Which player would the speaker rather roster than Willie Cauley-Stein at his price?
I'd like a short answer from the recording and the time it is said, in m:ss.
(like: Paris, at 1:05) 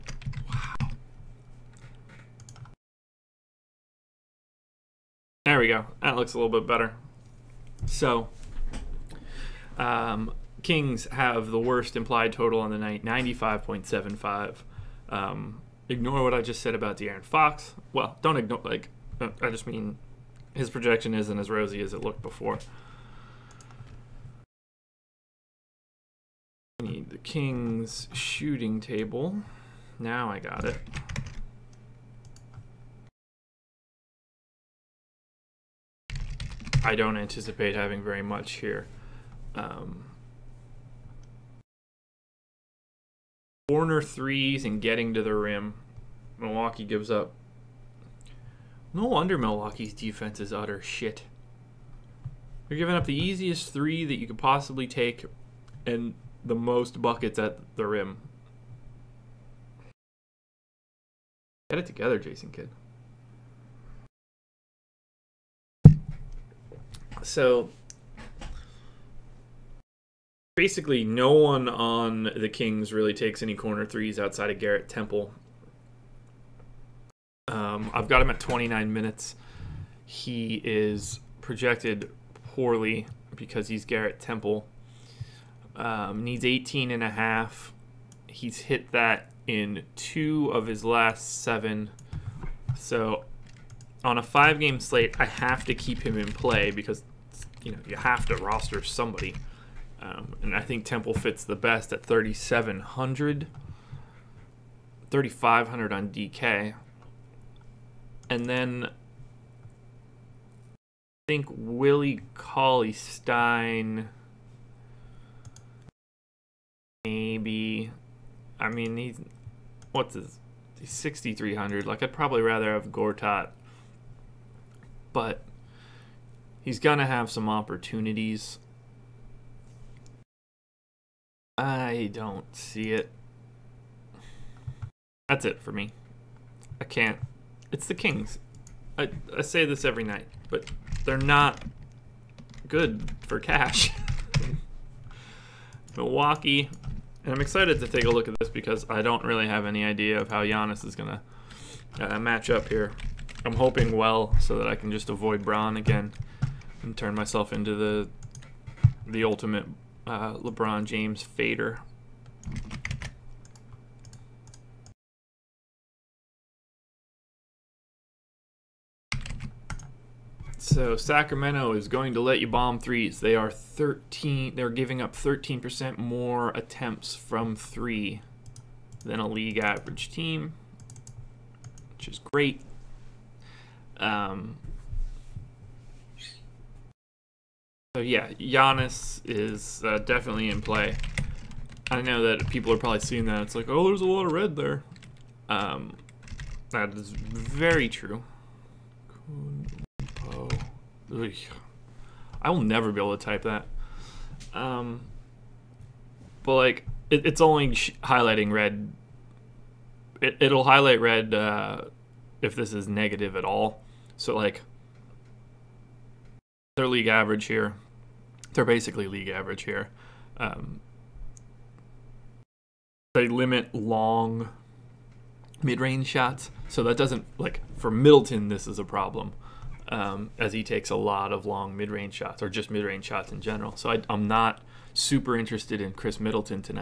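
Gortat, at 2:02.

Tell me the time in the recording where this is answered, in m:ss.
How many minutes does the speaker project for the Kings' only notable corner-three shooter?
1:18.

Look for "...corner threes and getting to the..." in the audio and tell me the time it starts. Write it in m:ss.
0:43.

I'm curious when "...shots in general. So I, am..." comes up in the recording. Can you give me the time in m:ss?
3:53.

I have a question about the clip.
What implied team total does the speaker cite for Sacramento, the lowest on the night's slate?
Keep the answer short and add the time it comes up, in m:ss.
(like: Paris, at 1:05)
95.75, at 0:13.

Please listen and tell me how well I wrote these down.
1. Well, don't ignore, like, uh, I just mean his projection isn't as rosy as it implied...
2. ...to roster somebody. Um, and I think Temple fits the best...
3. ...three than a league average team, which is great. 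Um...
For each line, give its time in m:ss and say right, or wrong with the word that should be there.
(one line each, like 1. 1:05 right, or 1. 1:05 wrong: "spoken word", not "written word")
1. 0:17 wrong: "looked", not "implied"
2. 1:38 right
3. 2:57 right.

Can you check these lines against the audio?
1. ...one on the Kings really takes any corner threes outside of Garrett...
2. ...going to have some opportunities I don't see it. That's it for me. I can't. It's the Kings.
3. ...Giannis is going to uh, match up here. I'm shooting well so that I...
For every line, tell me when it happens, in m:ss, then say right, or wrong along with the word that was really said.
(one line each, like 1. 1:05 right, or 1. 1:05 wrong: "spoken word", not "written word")
1. 1:11 right
2. 2:06 right
3. 2:30 wrong: "hoping", not "shooting".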